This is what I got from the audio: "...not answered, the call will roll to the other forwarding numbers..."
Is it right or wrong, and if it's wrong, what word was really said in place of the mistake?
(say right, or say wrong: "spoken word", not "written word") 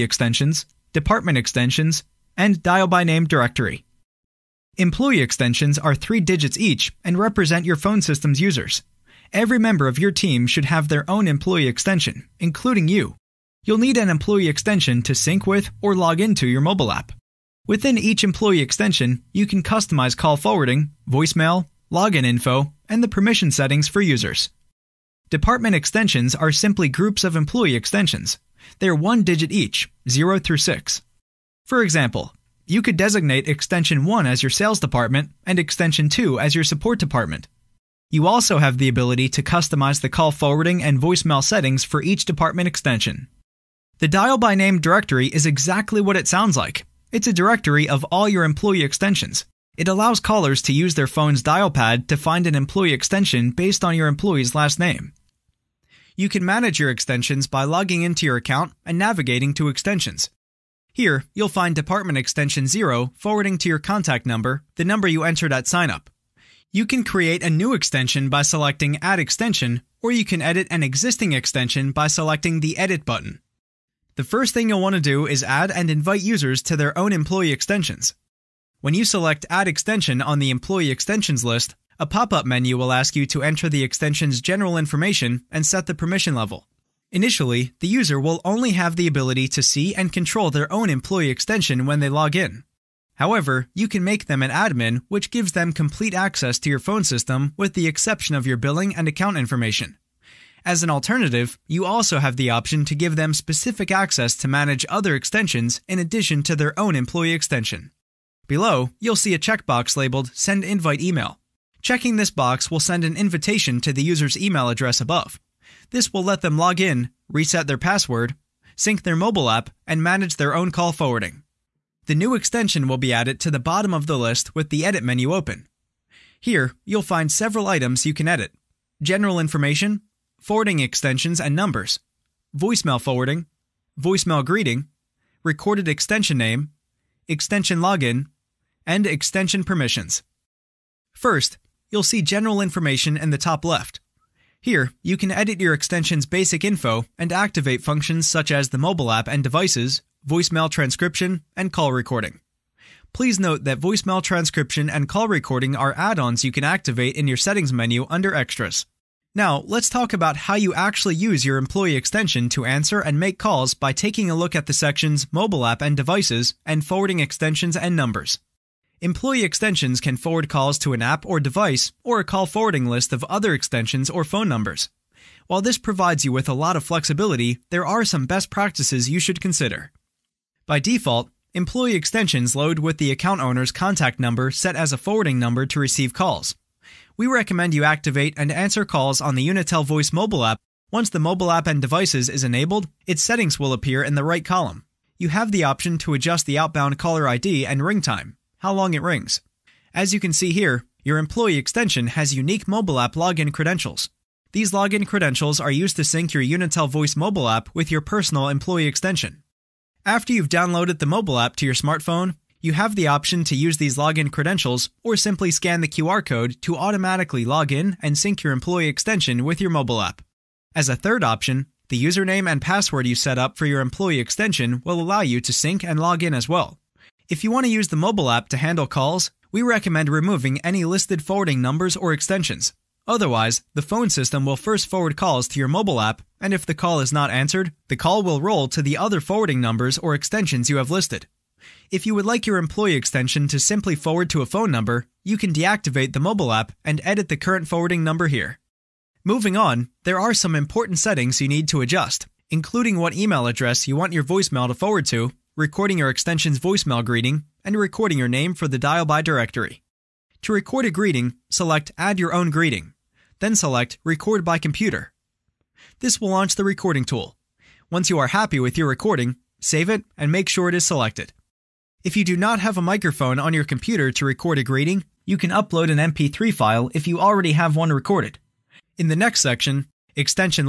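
right.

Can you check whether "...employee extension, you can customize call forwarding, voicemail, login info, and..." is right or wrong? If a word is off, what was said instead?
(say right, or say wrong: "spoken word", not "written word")
right.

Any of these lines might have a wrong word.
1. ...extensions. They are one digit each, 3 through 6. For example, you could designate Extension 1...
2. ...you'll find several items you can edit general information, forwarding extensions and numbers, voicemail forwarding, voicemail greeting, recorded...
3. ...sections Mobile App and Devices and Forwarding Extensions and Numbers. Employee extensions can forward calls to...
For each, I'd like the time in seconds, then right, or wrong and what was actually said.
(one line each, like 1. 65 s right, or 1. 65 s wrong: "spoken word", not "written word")
1. 27 s wrong: "0", not "3"
2. 126 s right
3. 164 s right.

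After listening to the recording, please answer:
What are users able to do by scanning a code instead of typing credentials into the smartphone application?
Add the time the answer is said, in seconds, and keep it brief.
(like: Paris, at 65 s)
Automatically log in, at 216 s.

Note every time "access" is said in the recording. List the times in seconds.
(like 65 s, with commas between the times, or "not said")
96 s, 103 s.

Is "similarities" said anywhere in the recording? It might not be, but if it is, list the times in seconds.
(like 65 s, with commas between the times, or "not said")
not said.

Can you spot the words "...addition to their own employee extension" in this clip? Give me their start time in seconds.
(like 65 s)
105 s.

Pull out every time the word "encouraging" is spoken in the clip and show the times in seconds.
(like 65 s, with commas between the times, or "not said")
not said.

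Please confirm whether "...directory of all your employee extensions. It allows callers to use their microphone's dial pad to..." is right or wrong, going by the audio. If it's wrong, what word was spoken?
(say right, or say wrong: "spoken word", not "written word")
wrong: "phone", not "microphone".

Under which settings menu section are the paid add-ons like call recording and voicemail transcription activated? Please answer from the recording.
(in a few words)
Extras.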